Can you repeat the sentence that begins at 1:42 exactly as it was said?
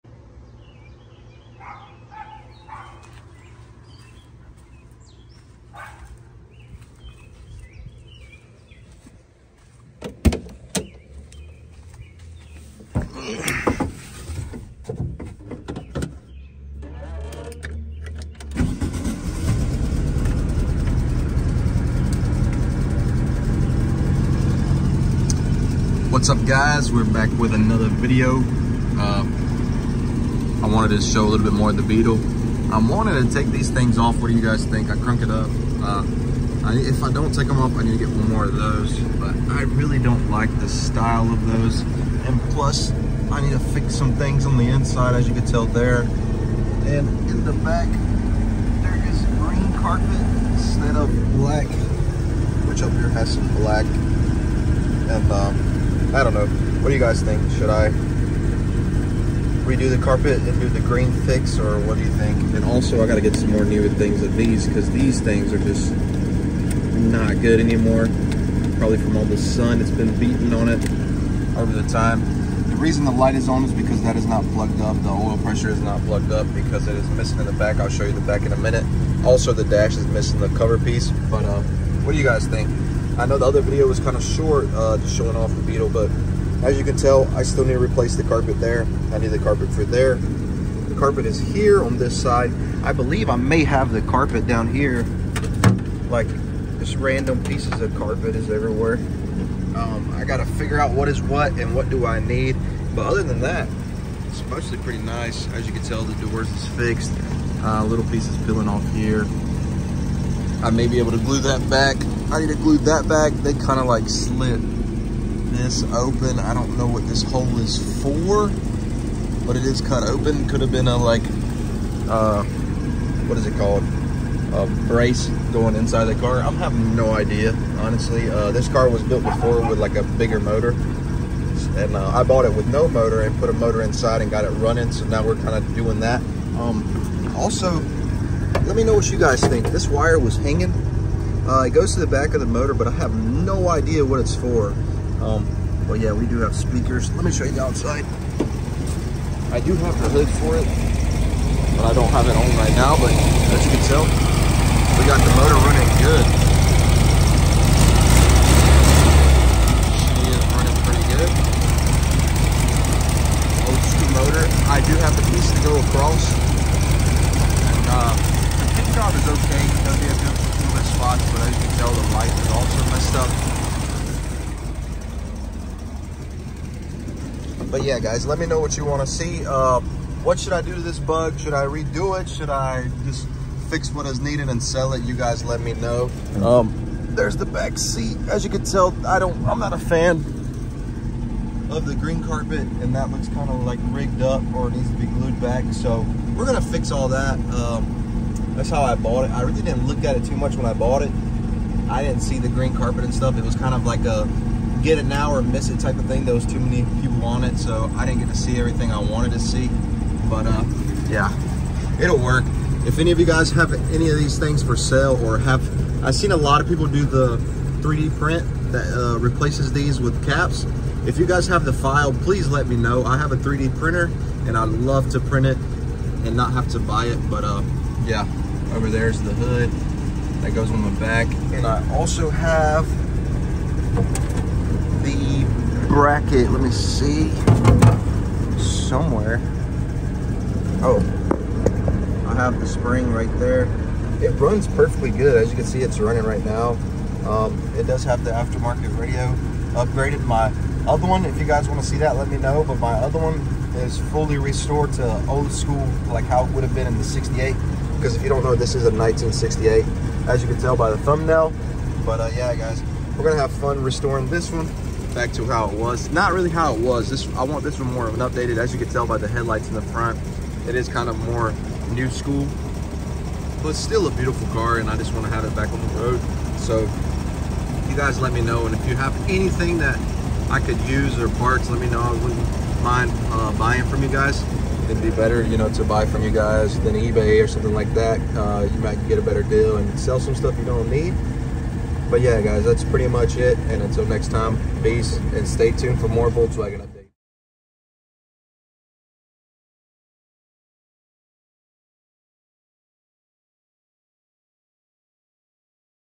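But other than that, it's mostly pretty nice.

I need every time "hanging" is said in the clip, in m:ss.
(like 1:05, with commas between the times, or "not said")
2:20.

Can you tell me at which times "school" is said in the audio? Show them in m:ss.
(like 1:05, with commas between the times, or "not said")
2:43, 4:15, 4:32.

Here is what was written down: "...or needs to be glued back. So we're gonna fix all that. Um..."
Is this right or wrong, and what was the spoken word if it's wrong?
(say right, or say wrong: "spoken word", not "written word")
right.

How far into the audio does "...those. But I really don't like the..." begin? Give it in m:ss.
0:38.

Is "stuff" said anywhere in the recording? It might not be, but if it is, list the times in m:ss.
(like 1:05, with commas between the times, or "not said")
3:23, 4:50.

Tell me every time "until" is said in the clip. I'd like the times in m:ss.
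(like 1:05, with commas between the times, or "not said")
4:53.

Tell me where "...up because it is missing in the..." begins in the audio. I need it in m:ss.
1:16.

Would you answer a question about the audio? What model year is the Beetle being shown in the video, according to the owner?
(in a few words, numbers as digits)
1968.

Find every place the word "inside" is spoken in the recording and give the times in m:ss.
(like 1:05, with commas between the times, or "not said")
0:44, 2:05, 2:13.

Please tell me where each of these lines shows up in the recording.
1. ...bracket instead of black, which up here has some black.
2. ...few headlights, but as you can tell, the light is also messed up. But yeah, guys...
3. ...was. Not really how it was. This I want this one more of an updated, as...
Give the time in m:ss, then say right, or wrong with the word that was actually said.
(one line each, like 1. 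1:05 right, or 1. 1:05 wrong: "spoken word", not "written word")
1. 0:49 wrong: "carpet", not "bracket"
2. 2:50 wrong: "spots", not "headlights"
3. 4:25 right.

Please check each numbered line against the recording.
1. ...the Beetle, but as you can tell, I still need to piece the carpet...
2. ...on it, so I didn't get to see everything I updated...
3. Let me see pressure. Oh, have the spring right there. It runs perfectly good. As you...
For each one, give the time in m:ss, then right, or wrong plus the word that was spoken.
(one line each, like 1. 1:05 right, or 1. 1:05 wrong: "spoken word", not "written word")
1. 1:25 wrong: "replace", not "piece"
2. 3:27 wrong: "wanted", not "updated"
3. 3:56 wrong: "somewhere", not "pressure".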